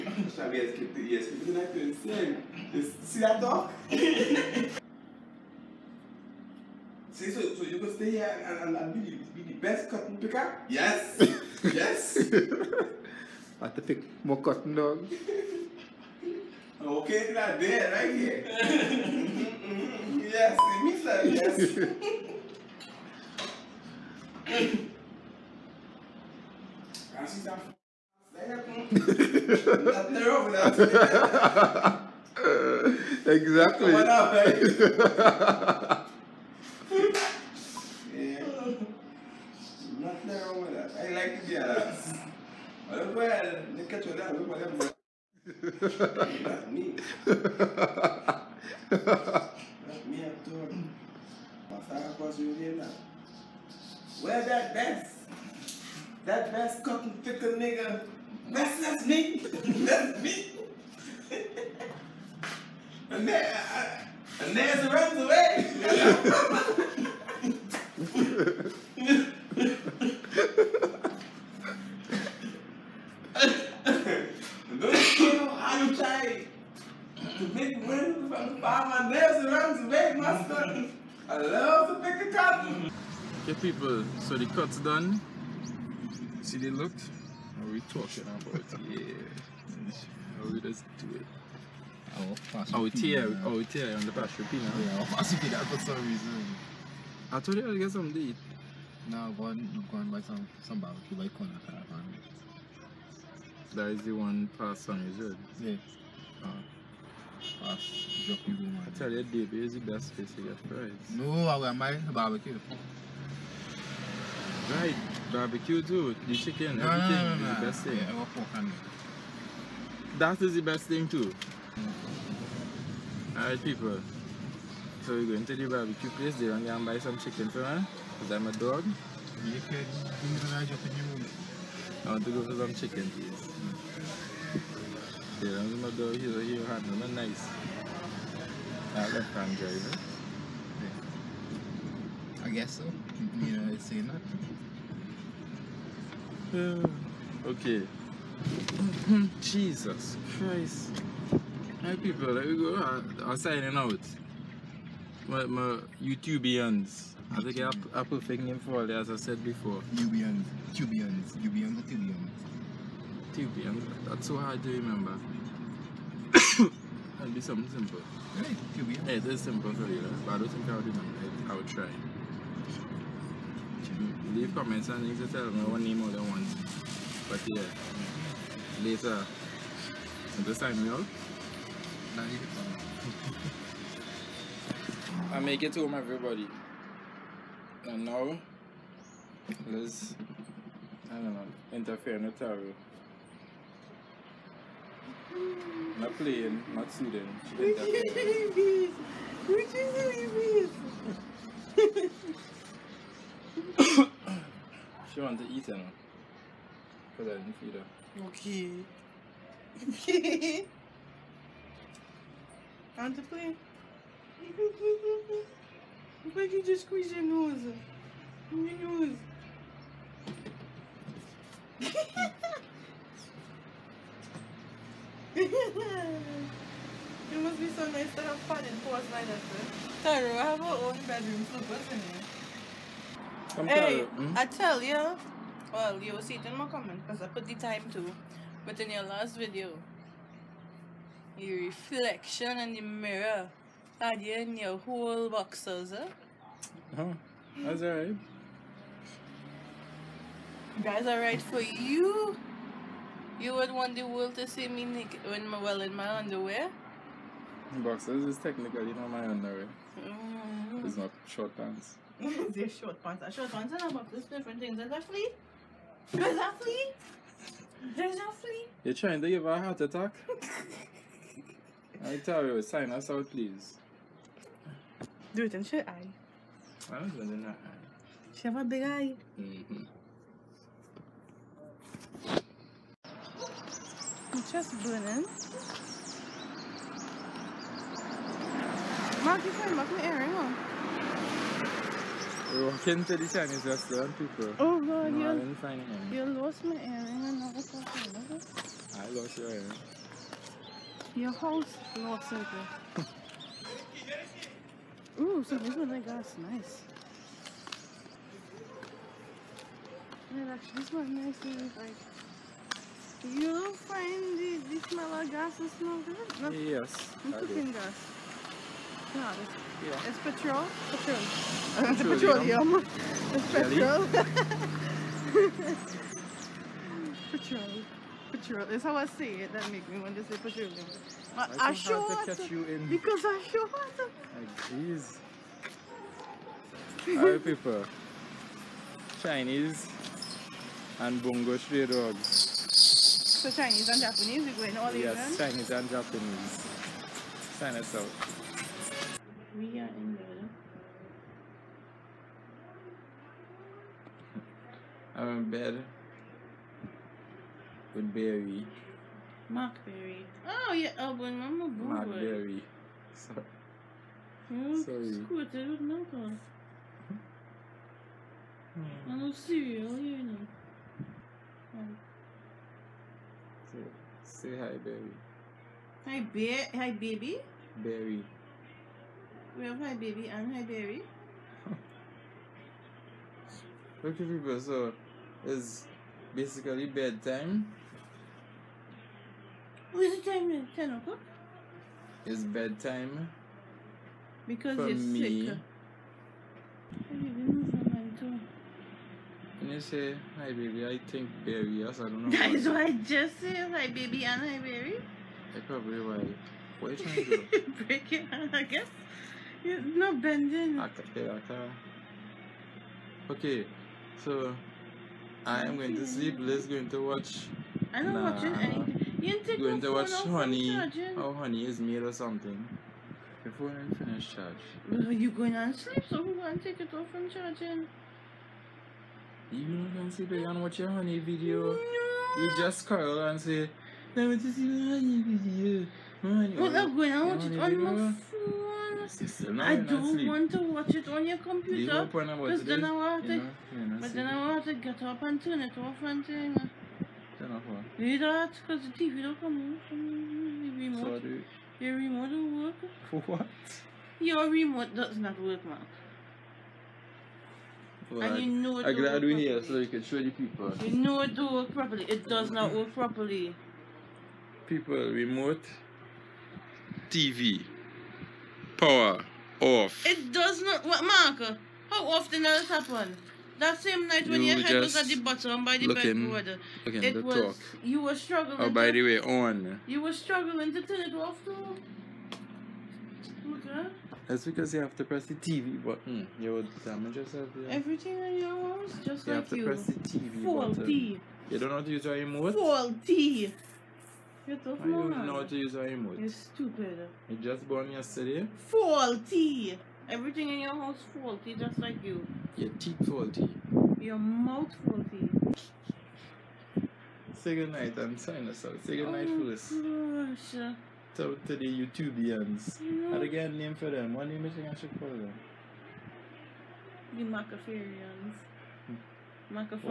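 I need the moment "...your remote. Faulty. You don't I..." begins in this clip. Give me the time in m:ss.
8:12.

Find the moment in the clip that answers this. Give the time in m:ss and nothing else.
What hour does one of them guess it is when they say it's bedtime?
6:30.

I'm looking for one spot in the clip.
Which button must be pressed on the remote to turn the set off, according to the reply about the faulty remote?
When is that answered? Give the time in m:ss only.
8:05.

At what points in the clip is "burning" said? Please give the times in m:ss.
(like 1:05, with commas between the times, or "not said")
4:44.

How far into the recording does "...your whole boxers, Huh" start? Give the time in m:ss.
4:04.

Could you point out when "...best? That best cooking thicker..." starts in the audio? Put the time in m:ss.
0:54.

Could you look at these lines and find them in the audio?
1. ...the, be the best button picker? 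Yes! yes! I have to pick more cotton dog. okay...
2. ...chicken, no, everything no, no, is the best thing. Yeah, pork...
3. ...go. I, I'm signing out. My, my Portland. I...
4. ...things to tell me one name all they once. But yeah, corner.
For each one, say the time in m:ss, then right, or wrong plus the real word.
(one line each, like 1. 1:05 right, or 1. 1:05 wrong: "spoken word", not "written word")
1. 0:09 wrong: "cotton", not "button"
2. 1:56 right
3. 2:32 wrong: "YouTubians", not "Portland"
4. 2:55 wrong: "later", not "corner".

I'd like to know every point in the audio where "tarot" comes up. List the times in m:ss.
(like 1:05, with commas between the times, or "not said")
3:12.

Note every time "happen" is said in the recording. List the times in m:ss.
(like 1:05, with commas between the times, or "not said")
7:52.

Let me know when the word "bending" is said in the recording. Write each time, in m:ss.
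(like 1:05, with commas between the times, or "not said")
6:50.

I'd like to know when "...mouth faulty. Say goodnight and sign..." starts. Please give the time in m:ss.
8:24.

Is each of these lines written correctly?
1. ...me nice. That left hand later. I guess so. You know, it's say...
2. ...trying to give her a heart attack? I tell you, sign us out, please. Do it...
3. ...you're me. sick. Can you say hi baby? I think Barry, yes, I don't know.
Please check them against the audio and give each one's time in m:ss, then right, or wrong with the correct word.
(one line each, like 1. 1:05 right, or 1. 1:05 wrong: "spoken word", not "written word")
1. 2:16 wrong: "driver", not "later"
2. 4:28 right
3. 6:34 right.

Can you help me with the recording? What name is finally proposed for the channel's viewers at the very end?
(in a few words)
The Macafarians.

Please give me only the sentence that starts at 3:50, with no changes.
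Tyro, I have our own bedroom, so what's in it?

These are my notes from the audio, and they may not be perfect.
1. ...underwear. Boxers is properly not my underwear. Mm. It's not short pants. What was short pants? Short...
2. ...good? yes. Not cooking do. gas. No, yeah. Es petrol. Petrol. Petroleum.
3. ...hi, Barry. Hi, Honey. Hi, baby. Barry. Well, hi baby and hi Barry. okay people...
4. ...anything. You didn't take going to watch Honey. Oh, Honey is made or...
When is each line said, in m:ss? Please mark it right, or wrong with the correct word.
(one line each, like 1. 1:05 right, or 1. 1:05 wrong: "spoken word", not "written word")
1. 4:16 wrong: "technically", not "properly"
2. 5:16 right
3. 6:14 wrong: "Bear", not "Honey"
4. 6:58 right.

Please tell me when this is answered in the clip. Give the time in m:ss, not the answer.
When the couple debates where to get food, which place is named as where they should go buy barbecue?
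1:41.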